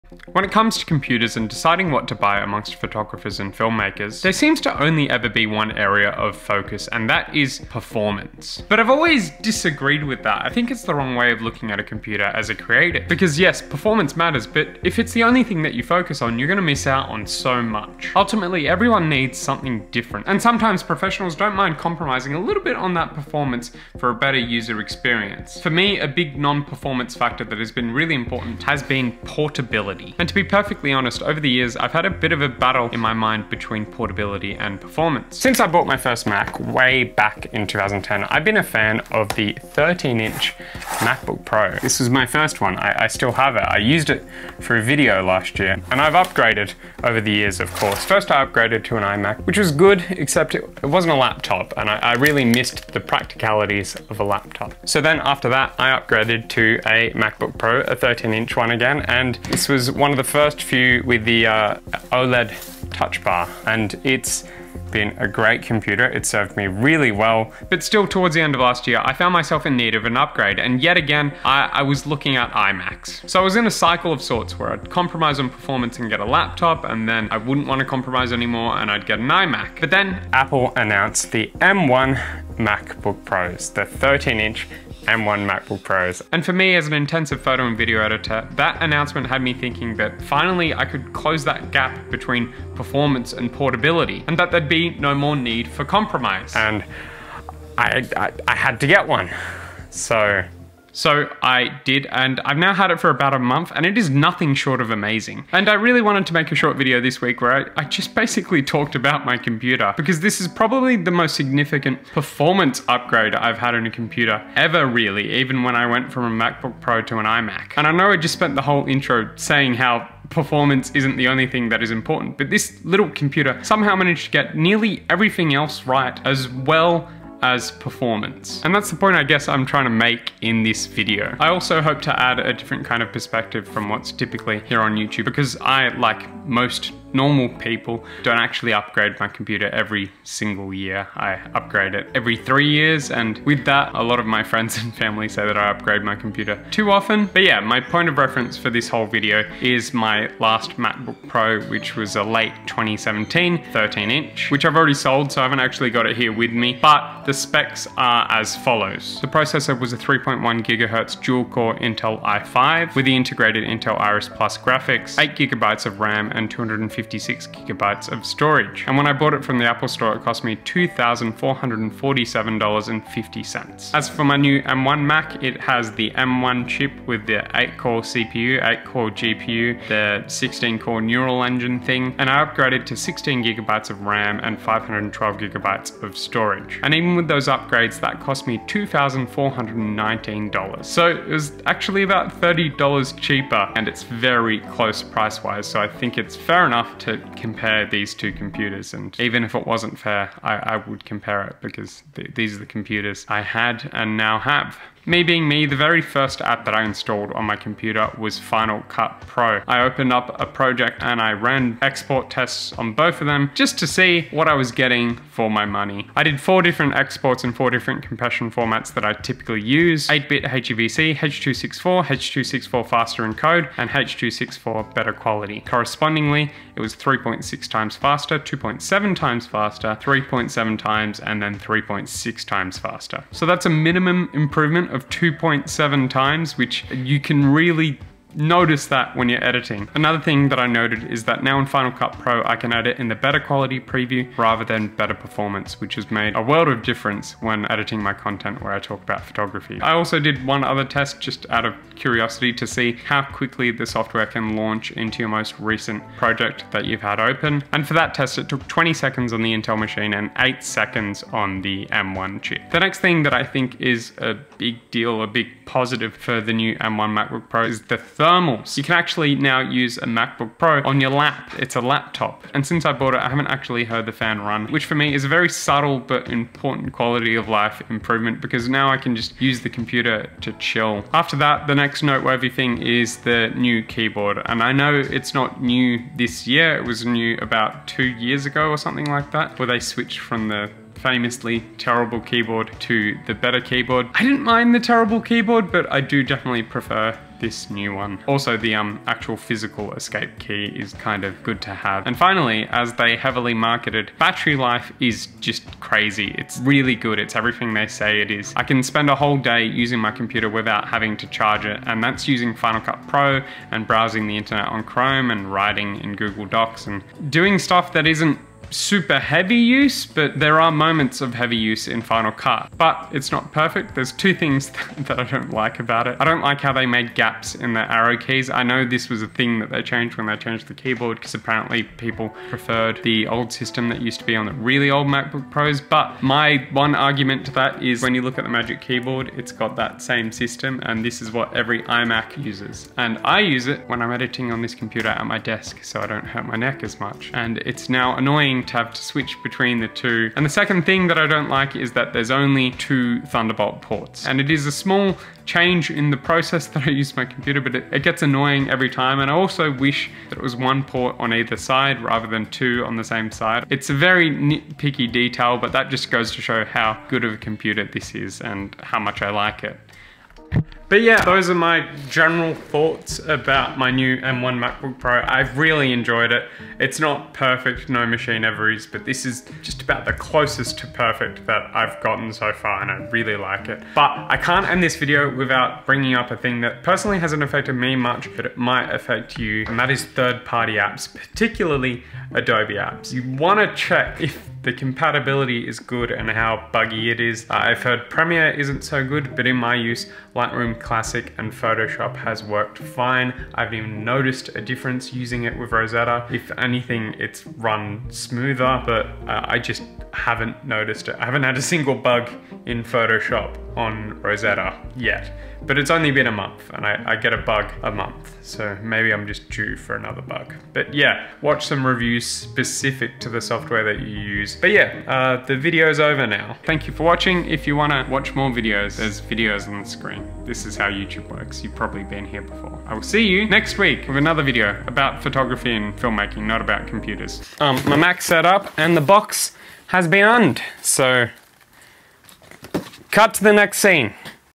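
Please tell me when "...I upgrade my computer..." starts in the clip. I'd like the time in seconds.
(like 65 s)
145 s.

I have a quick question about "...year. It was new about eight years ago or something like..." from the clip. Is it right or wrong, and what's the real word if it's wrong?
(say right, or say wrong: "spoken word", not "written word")
wrong: "two", not "eight".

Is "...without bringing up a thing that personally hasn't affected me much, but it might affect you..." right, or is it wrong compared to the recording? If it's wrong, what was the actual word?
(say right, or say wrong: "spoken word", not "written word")
right.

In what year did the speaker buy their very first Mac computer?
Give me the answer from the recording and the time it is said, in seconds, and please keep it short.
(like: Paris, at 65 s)
2010, at 37 s.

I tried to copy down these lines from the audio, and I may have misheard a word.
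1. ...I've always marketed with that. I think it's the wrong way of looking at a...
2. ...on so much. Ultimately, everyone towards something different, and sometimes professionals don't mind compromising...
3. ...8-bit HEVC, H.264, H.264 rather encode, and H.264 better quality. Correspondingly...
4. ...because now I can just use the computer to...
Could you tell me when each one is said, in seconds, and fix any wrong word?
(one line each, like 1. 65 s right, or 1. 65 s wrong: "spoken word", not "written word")
1. 8 s wrong: "disagreed", not "marketed"
2. 17 s wrong: "needs", not "towards"
3. 220 s wrong: "faster", not "rather"
4. 278 s right.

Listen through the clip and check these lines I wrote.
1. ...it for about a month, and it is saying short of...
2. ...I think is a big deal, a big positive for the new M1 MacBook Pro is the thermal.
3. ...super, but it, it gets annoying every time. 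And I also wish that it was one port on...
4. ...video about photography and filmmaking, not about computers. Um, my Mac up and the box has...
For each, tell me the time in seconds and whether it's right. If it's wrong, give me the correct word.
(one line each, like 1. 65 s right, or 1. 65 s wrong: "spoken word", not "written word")
1. 102 s wrong: "nothing", not "saying"
2. 263 s right
3. 357 s wrong: "computer", not "super"
4. 434 s right.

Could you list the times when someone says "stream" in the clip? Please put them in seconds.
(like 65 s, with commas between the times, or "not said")
not said.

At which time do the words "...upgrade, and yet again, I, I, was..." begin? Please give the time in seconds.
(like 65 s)
70 s.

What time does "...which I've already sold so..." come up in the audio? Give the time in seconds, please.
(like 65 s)
154 s.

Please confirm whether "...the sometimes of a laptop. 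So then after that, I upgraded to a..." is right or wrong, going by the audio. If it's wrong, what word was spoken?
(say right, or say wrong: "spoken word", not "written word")
wrong: "practicalities", not "sometimes".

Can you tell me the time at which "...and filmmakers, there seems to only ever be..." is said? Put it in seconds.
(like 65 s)
3 s.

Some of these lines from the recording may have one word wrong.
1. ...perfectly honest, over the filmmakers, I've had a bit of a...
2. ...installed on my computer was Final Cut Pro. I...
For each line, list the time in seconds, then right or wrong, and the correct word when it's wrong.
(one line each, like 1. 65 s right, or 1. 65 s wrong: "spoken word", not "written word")
1. 30 s wrong: "years", not "filmmakers"
2. 206 s right.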